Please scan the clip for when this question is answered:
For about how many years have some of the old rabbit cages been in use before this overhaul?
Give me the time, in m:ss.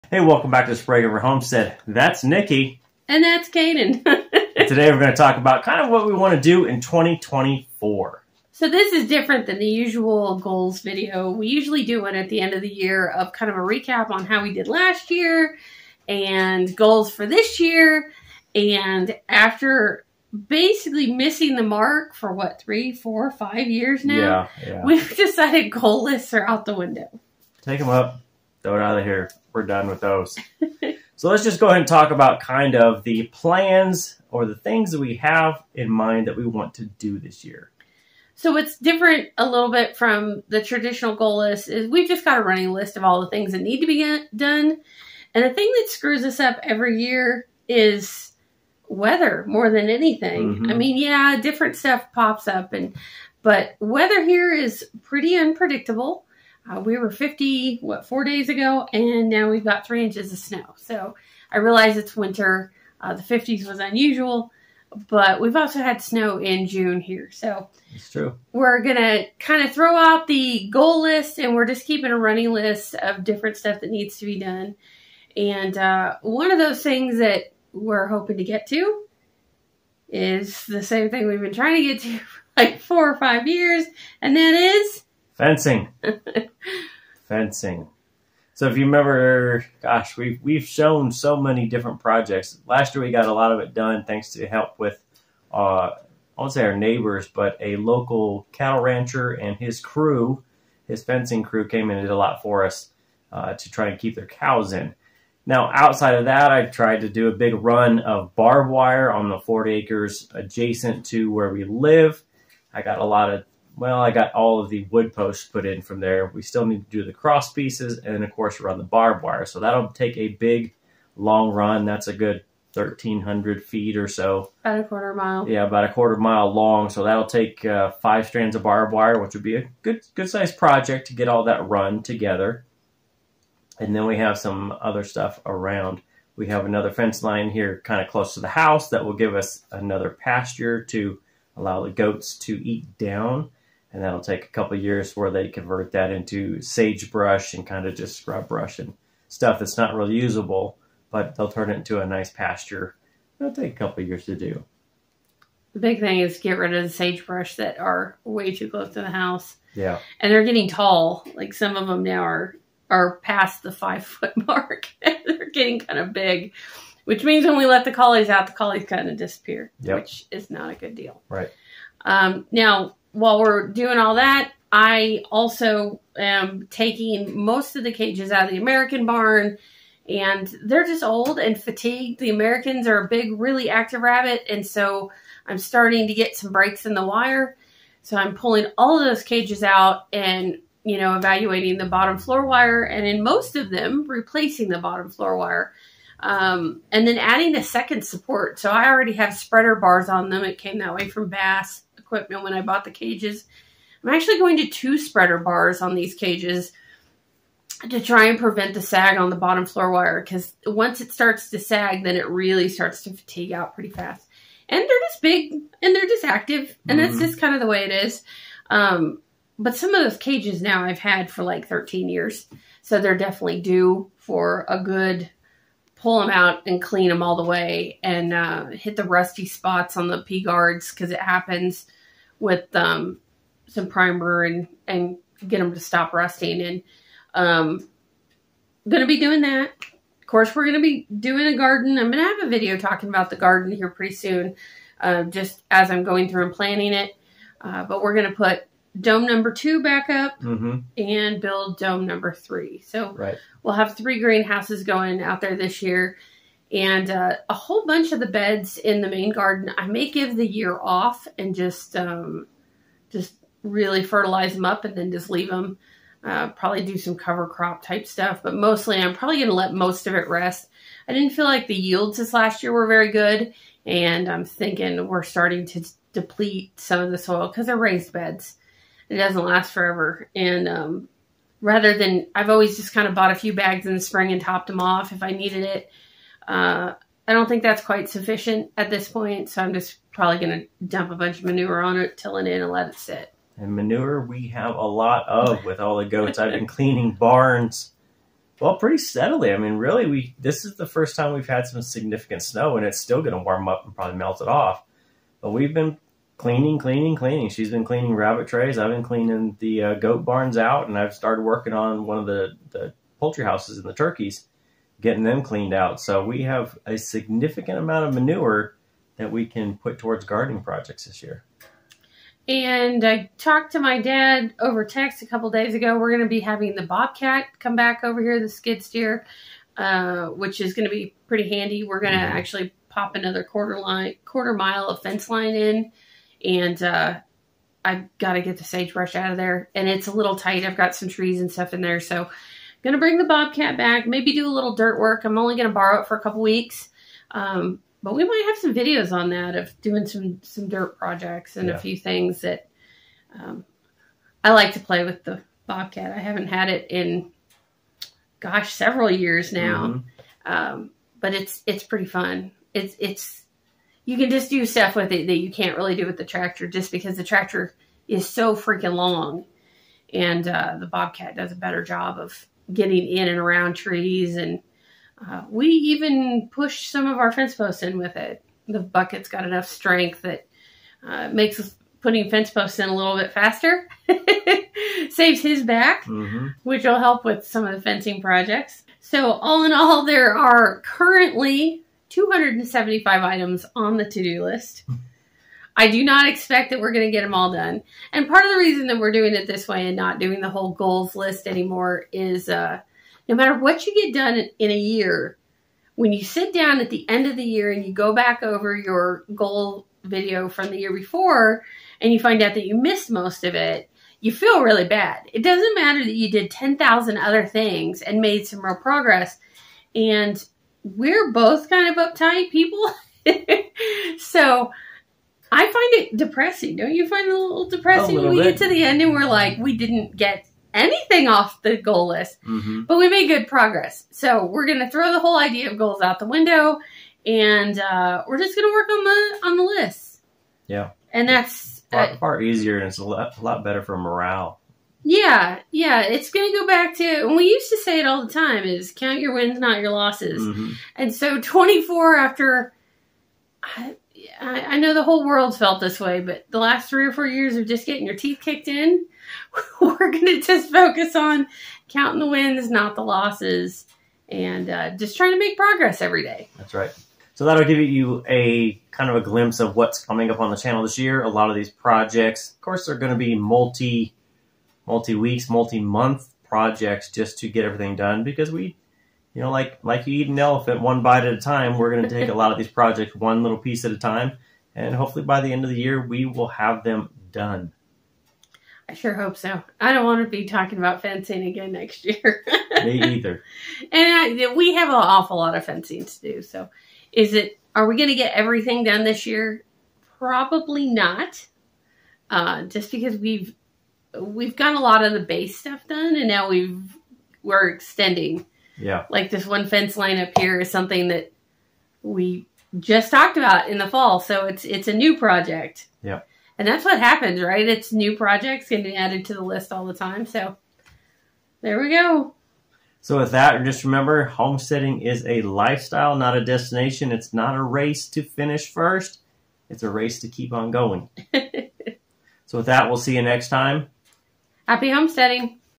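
3:41.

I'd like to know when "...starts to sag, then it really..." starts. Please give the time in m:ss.
3:31.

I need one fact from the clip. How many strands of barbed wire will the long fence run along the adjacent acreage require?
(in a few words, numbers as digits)
5.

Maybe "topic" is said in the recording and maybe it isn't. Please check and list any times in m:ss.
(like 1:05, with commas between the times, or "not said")
not said.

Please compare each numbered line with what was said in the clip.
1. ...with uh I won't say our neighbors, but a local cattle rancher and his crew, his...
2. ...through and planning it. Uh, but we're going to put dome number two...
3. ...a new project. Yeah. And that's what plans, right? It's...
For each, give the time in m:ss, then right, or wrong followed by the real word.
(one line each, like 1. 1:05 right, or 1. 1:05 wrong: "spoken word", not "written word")
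1. 1:34 right
2. 4:06 right
3. 8:34 wrong: "happens", not "plans".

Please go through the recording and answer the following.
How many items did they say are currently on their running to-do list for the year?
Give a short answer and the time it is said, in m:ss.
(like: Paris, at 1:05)
275, at 6:32.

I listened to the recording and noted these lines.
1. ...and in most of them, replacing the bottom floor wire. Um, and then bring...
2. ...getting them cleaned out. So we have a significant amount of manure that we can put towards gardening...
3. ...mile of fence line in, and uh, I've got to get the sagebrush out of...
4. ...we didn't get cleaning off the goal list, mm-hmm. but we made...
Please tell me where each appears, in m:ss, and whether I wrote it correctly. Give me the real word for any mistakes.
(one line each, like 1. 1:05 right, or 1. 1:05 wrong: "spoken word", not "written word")
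1. 3:12 wrong: "adding", not "bring"
2. 5:15 right
3. 5:34 right
4. 7:09 wrong: "anything", not "cleaning".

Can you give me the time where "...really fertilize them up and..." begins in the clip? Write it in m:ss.
4:23.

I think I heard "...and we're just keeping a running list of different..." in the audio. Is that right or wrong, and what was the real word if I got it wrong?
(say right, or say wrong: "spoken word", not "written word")
right.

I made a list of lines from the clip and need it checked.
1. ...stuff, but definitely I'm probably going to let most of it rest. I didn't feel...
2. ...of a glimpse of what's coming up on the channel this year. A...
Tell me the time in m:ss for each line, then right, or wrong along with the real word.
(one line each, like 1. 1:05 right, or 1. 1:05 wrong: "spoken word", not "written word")
1. 4:28 wrong: "mostly", not "definitely"
2. 7:49 right.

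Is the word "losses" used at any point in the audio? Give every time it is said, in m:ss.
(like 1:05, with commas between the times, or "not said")
7:29, 7:43.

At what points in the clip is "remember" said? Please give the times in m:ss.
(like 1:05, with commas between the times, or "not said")
1:28, 8:43.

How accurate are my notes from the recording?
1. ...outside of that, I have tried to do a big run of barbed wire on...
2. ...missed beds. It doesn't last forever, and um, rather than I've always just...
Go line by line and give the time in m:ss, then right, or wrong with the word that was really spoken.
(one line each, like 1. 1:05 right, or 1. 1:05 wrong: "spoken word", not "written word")
1. 1:45 right
2. 4:37 wrong: "raised", not "missed".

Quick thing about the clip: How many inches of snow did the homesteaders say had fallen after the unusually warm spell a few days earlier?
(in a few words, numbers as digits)
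3.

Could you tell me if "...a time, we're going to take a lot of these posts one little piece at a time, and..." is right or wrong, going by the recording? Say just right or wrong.
wrong.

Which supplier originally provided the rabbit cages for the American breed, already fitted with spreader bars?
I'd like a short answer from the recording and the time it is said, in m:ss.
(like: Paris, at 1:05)
Bass equipment, at 3:21.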